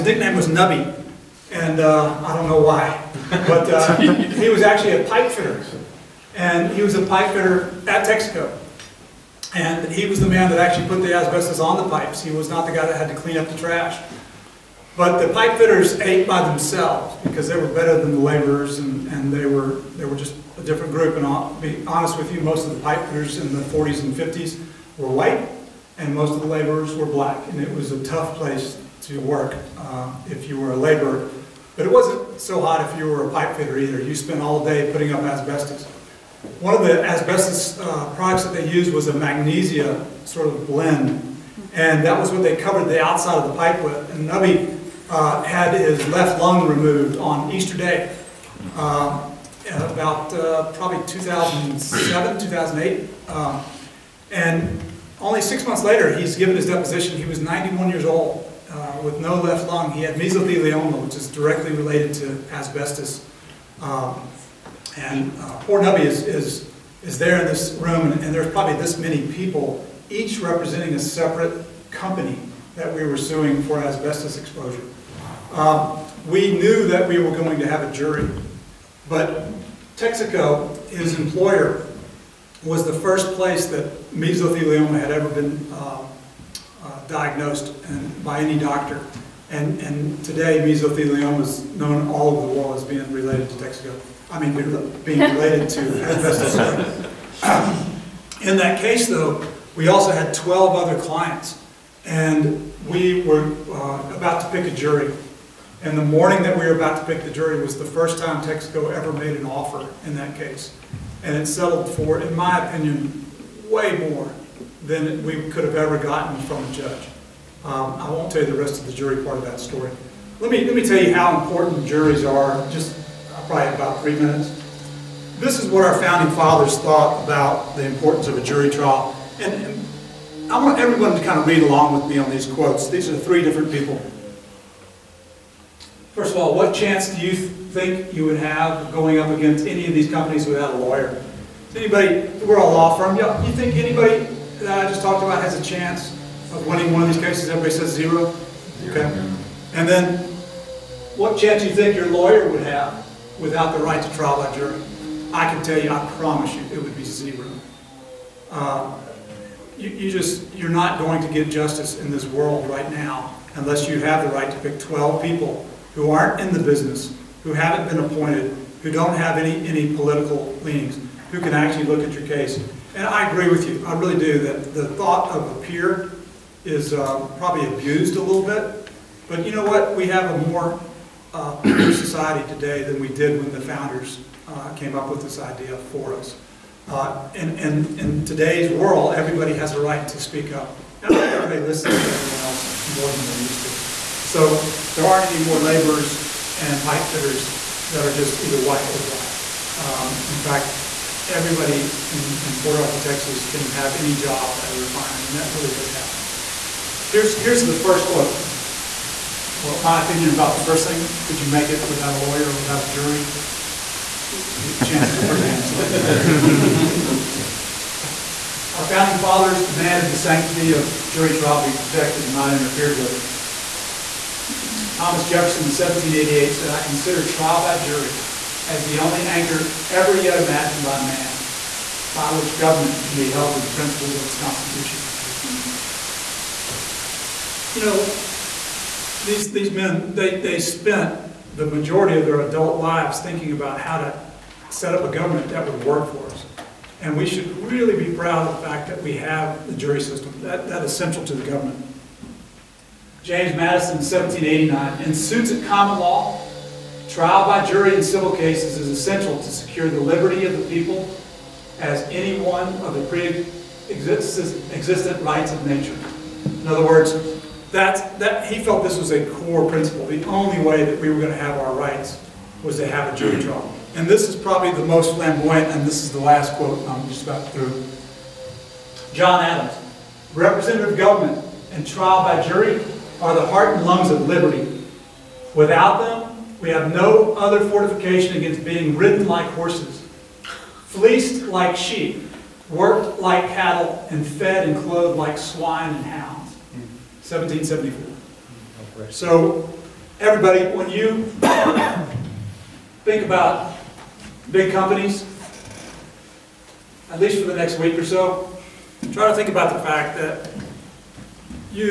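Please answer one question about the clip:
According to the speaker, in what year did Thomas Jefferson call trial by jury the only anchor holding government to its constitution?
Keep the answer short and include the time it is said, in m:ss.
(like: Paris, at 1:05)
1788, at 3:45.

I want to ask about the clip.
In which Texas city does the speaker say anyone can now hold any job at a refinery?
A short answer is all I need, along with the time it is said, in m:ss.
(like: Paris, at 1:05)
Port Arthur, at 3:22.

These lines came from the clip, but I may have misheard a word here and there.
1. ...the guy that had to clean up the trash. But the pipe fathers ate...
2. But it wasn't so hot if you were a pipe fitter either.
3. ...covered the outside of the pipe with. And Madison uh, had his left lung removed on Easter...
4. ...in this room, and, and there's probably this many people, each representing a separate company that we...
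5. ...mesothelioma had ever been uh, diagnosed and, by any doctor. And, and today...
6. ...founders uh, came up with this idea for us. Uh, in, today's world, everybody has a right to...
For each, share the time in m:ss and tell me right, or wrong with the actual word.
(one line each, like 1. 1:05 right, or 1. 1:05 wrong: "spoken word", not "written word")
1. 0:12 wrong: "fitters", not "fathers"
2. 0:31 right
3. 0:42 wrong: "Nubby", not "Madison"
4. 1:07 right
5. 1:24 right
6. 3:03 right.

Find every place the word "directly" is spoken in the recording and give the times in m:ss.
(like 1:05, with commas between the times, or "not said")
1:01.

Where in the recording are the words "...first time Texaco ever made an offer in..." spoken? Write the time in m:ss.
1:47.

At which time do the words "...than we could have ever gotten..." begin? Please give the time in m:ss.
1:54.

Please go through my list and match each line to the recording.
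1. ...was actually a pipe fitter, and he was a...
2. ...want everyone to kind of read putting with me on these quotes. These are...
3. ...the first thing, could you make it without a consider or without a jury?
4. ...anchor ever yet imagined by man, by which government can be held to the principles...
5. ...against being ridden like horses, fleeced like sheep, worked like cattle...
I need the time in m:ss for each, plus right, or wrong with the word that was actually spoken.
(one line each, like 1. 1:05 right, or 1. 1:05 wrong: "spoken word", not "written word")
1. 0:04 right
2. 2:10 wrong: "along", not "putting"
3. 3:30 wrong: "lawyer", not "consider"
4. 3:49 right
5. 4:48 right.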